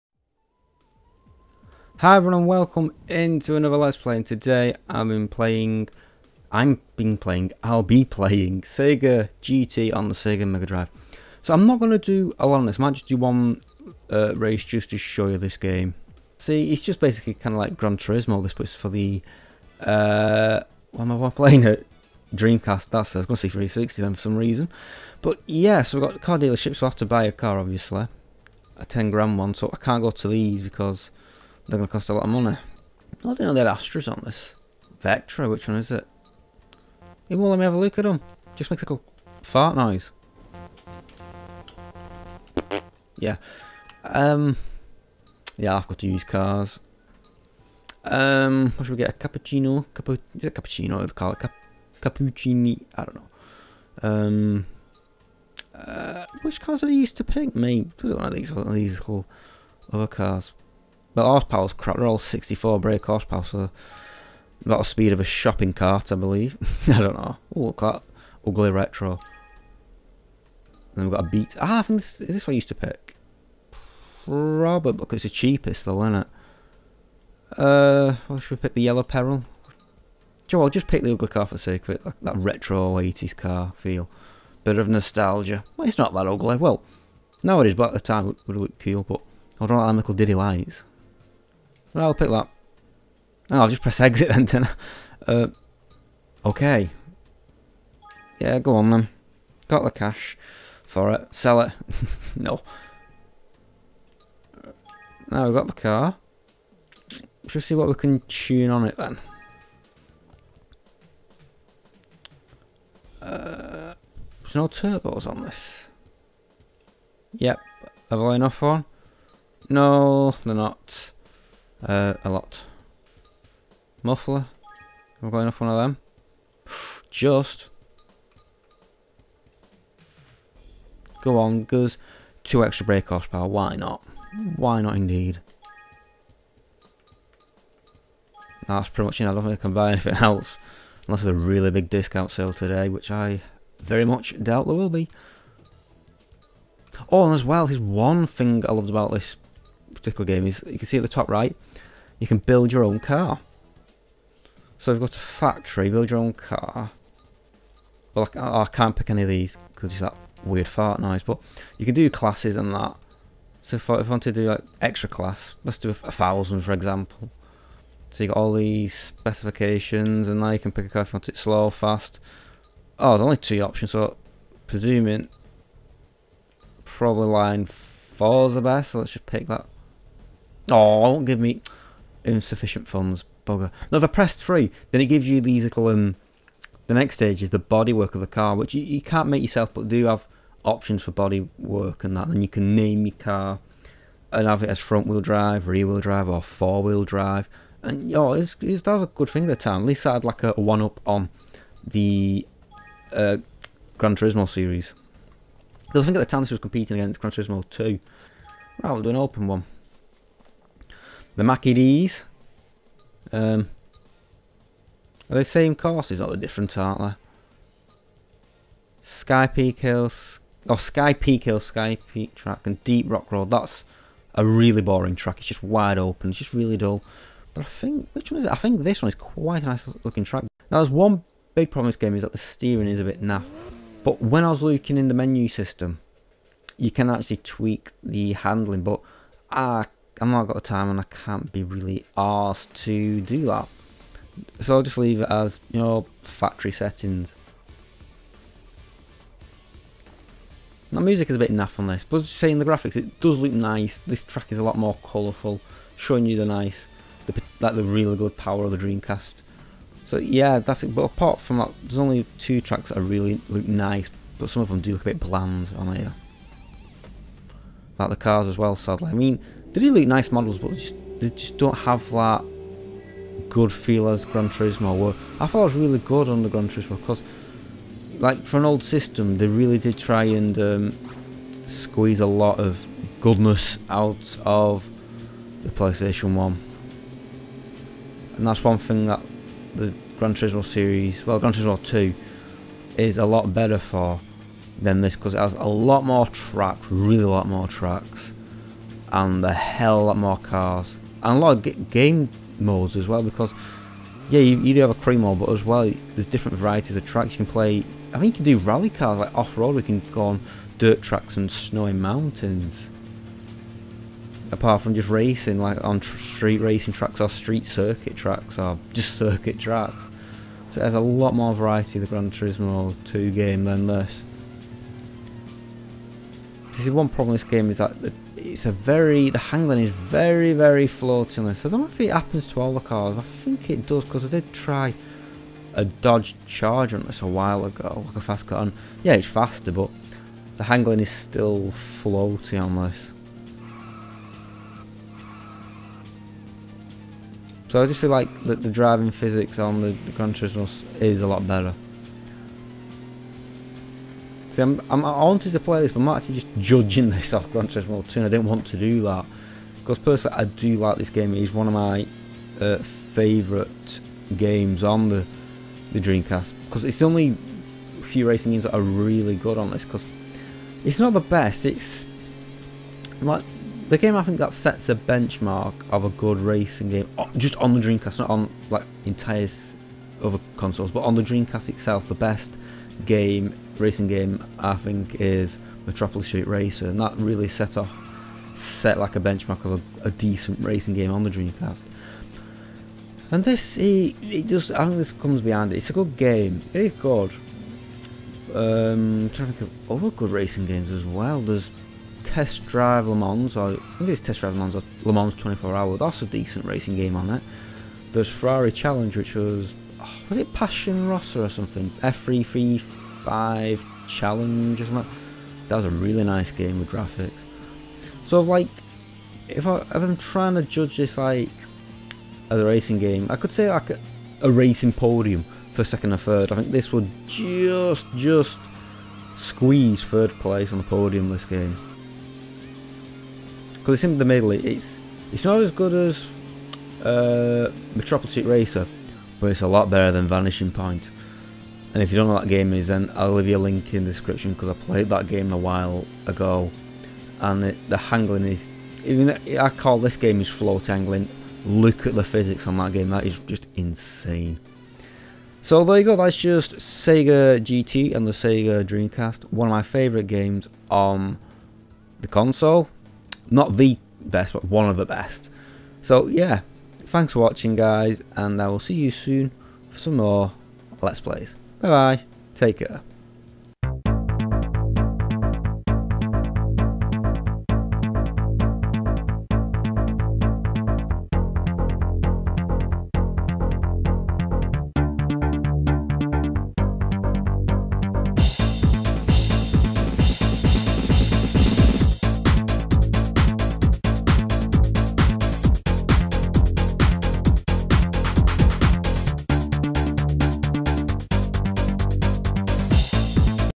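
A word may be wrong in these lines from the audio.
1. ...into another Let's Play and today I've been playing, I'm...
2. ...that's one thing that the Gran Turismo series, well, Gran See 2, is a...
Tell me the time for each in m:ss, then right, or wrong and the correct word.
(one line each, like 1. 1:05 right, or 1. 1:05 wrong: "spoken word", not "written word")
1. 0:03 right
2. 4:48 wrong: "Turismo", not "See".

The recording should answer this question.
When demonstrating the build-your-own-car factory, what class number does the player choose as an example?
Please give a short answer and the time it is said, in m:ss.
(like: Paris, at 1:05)
1000, at 2:46.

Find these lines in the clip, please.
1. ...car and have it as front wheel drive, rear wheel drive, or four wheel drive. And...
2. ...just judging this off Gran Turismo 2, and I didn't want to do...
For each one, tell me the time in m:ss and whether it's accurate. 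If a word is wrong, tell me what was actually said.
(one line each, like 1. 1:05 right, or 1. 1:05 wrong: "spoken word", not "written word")
1. 3:13 right
2. 5:56 right.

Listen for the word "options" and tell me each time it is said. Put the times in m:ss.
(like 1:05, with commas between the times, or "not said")
2:53, 3:10.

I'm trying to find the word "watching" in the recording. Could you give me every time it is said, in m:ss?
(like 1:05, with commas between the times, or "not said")
7:47.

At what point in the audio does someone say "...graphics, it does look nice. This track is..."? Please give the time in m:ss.
4:12.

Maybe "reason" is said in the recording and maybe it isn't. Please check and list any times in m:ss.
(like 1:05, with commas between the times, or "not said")
0:24.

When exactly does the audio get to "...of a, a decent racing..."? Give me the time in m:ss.
6:29.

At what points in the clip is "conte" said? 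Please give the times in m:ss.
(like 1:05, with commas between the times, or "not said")
not said.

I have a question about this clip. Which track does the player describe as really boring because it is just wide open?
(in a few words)
Deep Rock Road.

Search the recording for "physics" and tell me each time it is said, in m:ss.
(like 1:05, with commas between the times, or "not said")
5:49, 7:32.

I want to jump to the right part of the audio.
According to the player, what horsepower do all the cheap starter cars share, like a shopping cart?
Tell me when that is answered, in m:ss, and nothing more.
1:02.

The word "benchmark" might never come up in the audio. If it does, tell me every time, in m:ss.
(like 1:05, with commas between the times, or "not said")
6:14, 6:29.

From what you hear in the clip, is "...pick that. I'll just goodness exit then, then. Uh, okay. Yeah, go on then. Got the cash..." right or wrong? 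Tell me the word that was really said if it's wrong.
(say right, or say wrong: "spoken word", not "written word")
wrong: "press", not "goodness".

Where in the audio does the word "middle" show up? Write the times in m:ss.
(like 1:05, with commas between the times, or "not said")
7:14.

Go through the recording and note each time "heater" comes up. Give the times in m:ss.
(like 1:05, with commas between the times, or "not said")
not said.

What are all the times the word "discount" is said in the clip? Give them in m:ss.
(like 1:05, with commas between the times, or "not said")
2:21.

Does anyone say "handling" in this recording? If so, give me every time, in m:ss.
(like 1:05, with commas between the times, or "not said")
3:58, 5:29, 5:40.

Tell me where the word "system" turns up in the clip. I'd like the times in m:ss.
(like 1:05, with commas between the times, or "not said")
3:55, 4:38.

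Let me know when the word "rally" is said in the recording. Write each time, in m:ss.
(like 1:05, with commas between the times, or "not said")
5:08.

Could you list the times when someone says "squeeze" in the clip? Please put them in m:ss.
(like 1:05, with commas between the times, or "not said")
4:41, 7:09.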